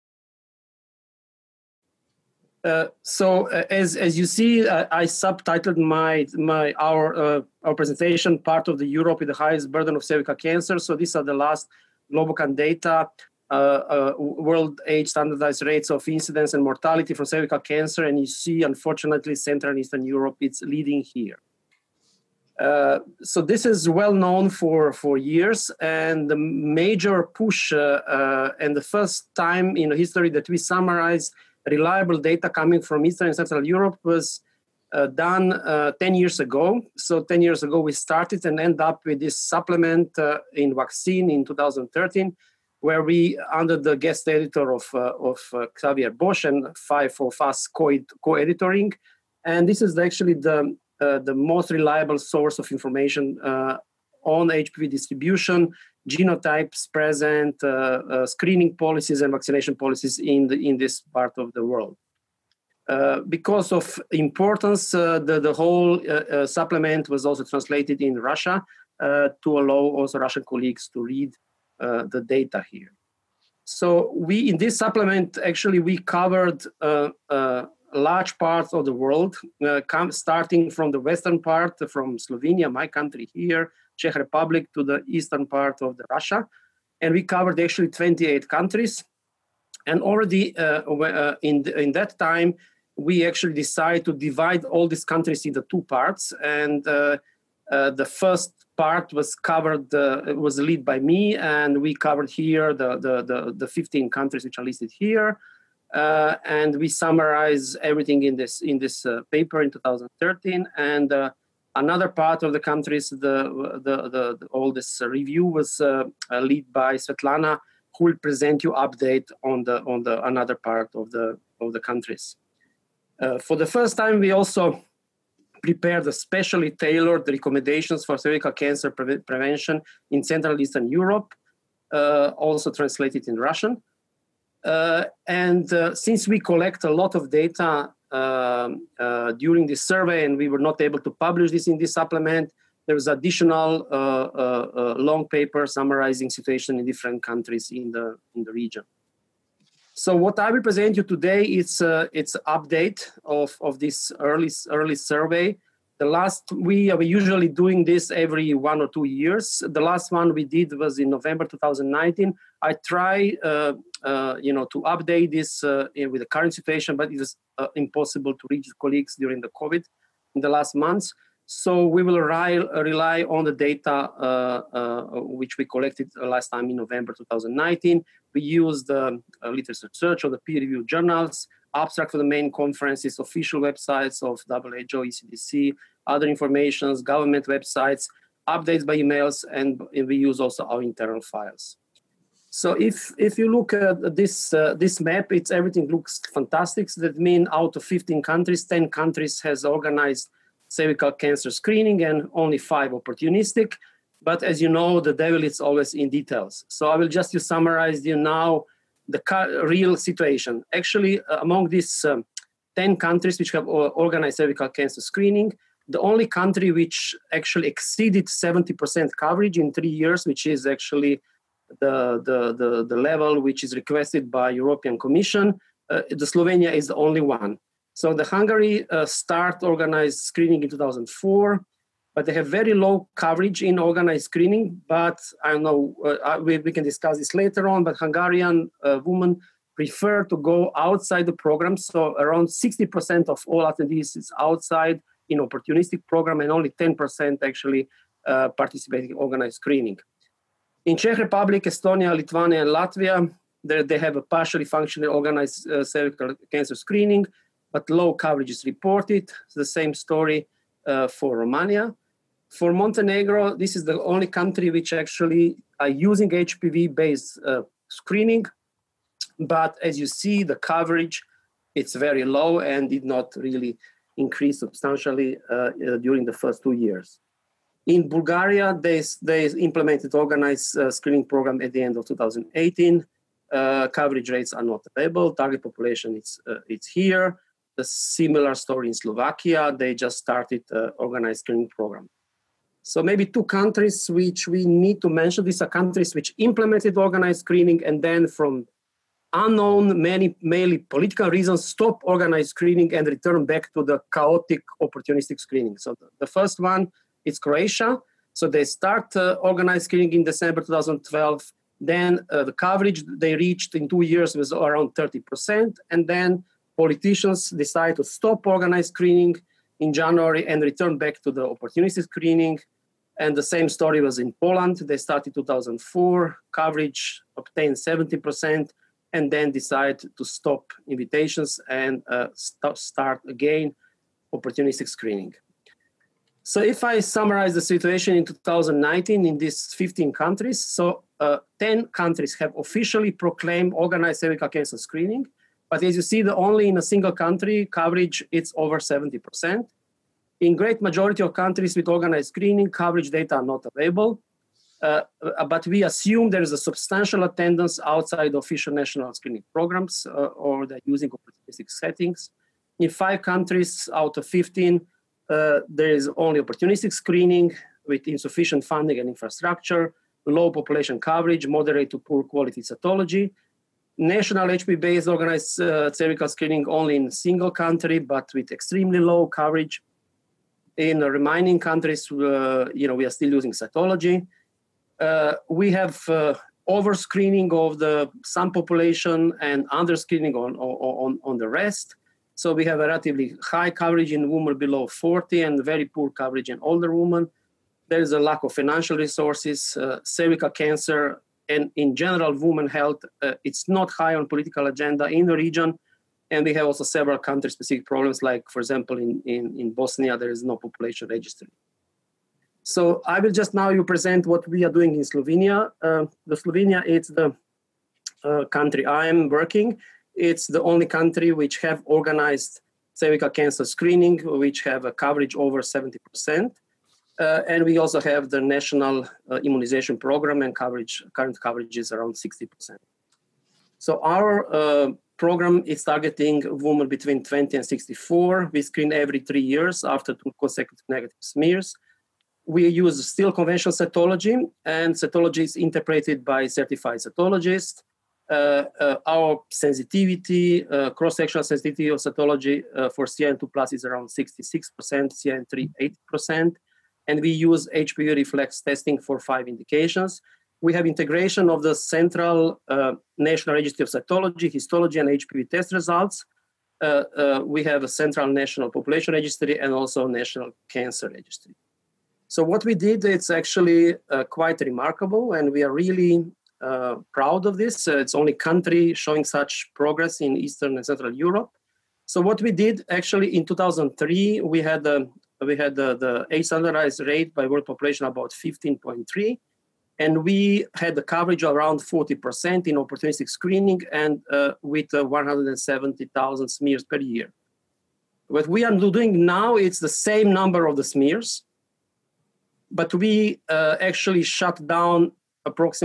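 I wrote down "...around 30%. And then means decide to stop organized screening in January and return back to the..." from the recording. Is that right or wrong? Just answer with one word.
wrong.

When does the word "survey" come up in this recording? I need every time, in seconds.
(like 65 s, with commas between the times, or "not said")
139 s, 154 s.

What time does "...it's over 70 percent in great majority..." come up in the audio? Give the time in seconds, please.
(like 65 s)
348 s.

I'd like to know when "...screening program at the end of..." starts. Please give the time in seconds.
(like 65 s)
280 s.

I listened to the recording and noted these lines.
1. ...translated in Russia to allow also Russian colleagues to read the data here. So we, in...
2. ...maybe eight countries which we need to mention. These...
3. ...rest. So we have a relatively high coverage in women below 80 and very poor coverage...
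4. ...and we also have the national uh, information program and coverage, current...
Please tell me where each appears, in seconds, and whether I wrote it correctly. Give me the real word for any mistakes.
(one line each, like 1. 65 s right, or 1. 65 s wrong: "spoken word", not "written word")
1. 67 s right
2. 293 s wrong: "two", not "eight"
3. 391 s wrong: "40", not "80"
4. 427 s wrong: "immunization", not "information".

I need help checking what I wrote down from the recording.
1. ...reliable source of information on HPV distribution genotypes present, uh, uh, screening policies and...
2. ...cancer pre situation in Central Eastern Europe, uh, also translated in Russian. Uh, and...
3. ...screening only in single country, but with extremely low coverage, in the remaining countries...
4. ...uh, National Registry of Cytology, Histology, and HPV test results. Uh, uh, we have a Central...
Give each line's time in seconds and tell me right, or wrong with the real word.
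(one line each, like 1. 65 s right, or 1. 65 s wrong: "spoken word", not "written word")
1. 51 s right
2. 128 s wrong: "prevention", not "situation"
3. 376 s right
4. 462 s right.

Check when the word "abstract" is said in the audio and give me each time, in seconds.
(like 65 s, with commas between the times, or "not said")
181 s.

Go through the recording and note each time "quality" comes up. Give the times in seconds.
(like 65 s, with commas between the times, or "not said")
372 s.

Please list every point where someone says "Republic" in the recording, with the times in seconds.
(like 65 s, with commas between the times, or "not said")
84 s, 251 s.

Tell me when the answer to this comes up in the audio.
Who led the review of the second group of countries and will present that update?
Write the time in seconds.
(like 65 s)
116 s.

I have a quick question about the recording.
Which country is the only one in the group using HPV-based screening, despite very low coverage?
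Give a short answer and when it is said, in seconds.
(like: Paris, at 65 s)
Montenegro, at 262 s.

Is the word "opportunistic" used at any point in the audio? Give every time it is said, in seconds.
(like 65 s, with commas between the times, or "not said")
202 s, 245 s, 304 s, 321 s, 334 s, 361 s, 366 s, 492 s.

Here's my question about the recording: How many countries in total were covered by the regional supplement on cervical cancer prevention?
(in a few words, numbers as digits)
28.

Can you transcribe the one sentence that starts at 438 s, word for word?
We screen every three years after two consecutive negative smears.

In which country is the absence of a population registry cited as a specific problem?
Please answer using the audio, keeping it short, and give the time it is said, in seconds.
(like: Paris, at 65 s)
Bosnia, at 409 s.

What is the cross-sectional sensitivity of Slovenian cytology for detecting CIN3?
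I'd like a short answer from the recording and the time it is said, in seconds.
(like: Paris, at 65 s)
80%, at 456 s.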